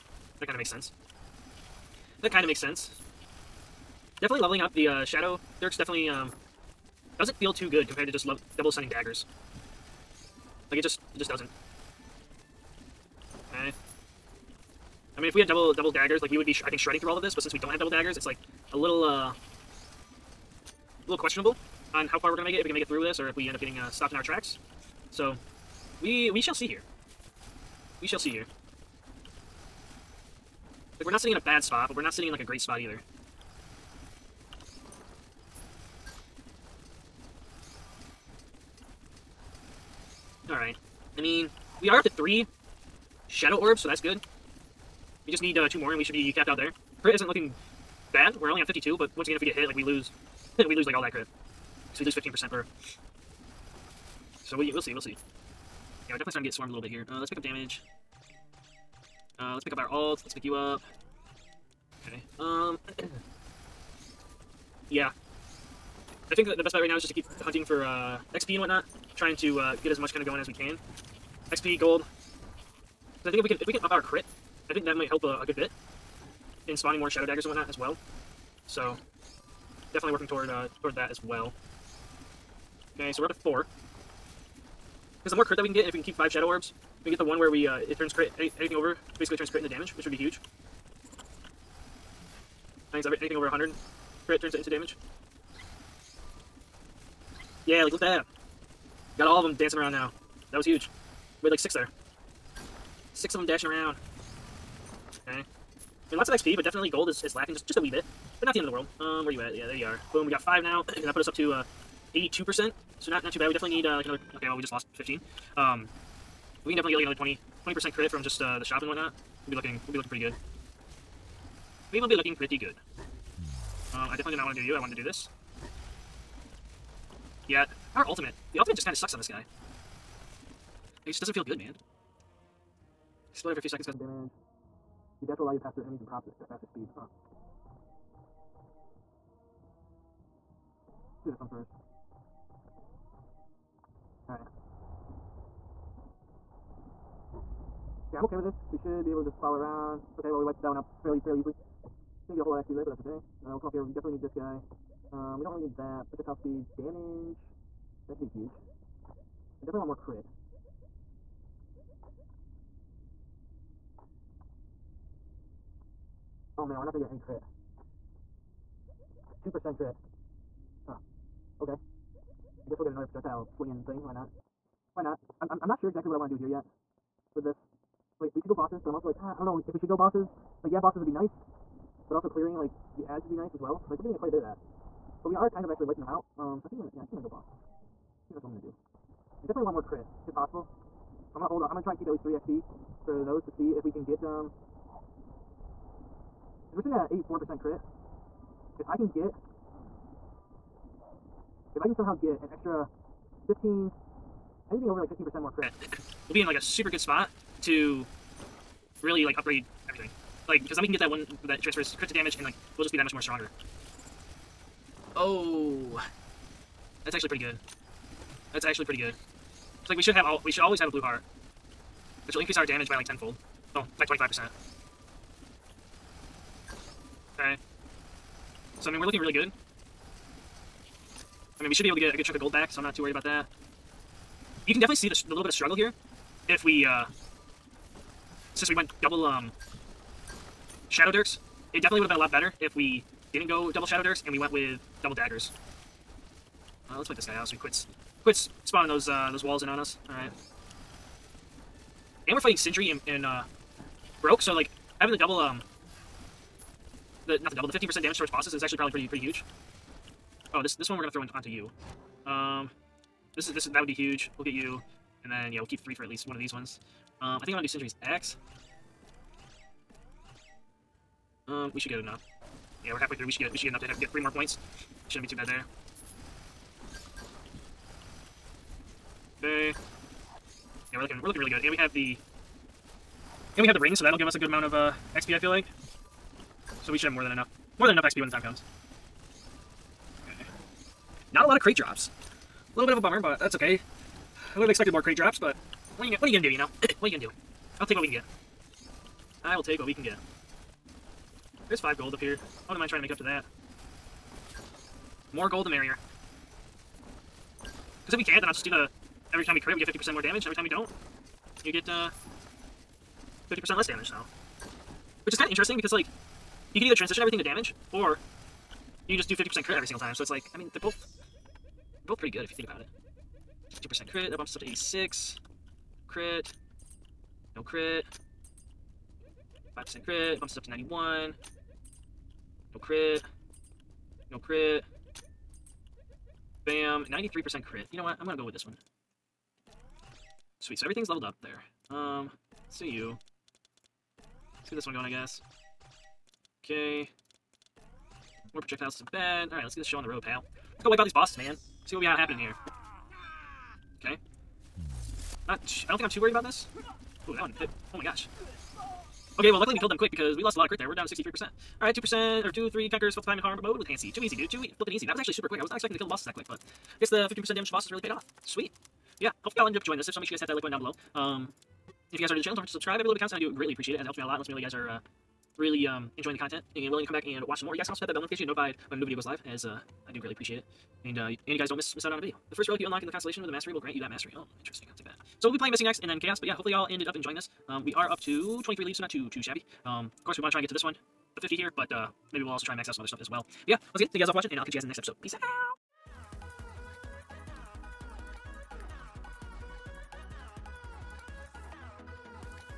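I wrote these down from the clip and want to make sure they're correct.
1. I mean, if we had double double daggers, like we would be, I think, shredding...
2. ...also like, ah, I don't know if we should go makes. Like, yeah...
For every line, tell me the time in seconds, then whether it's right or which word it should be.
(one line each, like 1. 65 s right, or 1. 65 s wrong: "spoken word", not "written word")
1. 15 s right
2. 178 s wrong: "bosses", not "makes".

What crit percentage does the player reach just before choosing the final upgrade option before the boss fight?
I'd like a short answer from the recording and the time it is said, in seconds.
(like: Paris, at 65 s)
93%, at 337 s.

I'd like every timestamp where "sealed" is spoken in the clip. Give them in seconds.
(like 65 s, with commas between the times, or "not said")
not said.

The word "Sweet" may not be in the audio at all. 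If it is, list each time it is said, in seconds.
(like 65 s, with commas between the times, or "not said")
340 s, 368 s.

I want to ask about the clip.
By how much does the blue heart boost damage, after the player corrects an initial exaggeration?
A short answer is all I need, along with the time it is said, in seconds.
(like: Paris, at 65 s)
25%, at 224 s.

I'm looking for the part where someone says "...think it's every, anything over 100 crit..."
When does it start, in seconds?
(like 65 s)
92 s.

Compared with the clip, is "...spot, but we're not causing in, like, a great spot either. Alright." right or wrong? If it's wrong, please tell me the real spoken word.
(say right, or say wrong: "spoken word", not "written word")
wrong: "sitting", not "causing".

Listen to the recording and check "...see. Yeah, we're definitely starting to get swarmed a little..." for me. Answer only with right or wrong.
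right.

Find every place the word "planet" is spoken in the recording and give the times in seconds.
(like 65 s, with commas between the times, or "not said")
not said.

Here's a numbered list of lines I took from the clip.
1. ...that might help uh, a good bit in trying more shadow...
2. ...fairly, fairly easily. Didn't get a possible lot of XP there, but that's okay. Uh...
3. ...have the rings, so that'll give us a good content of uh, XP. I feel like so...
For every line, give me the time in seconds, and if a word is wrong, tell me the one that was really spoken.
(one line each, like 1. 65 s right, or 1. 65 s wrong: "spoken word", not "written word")
1. 74 s wrong: "spawning", not "trying"
2. 151 s wrong: "whole", not "possible"
3. 283 s wrong: "amount", not "content".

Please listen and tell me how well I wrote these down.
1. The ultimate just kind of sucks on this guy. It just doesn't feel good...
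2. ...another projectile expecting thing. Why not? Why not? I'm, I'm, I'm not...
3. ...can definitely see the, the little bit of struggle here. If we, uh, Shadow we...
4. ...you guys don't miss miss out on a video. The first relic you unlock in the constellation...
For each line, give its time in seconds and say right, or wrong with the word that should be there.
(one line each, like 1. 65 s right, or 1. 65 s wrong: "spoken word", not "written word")
1. 128 s right
2. 172 s wrong: "slinging", not "expecting"
3. 234 s wrong: "Since", not "Shadow"
4. 381 s right.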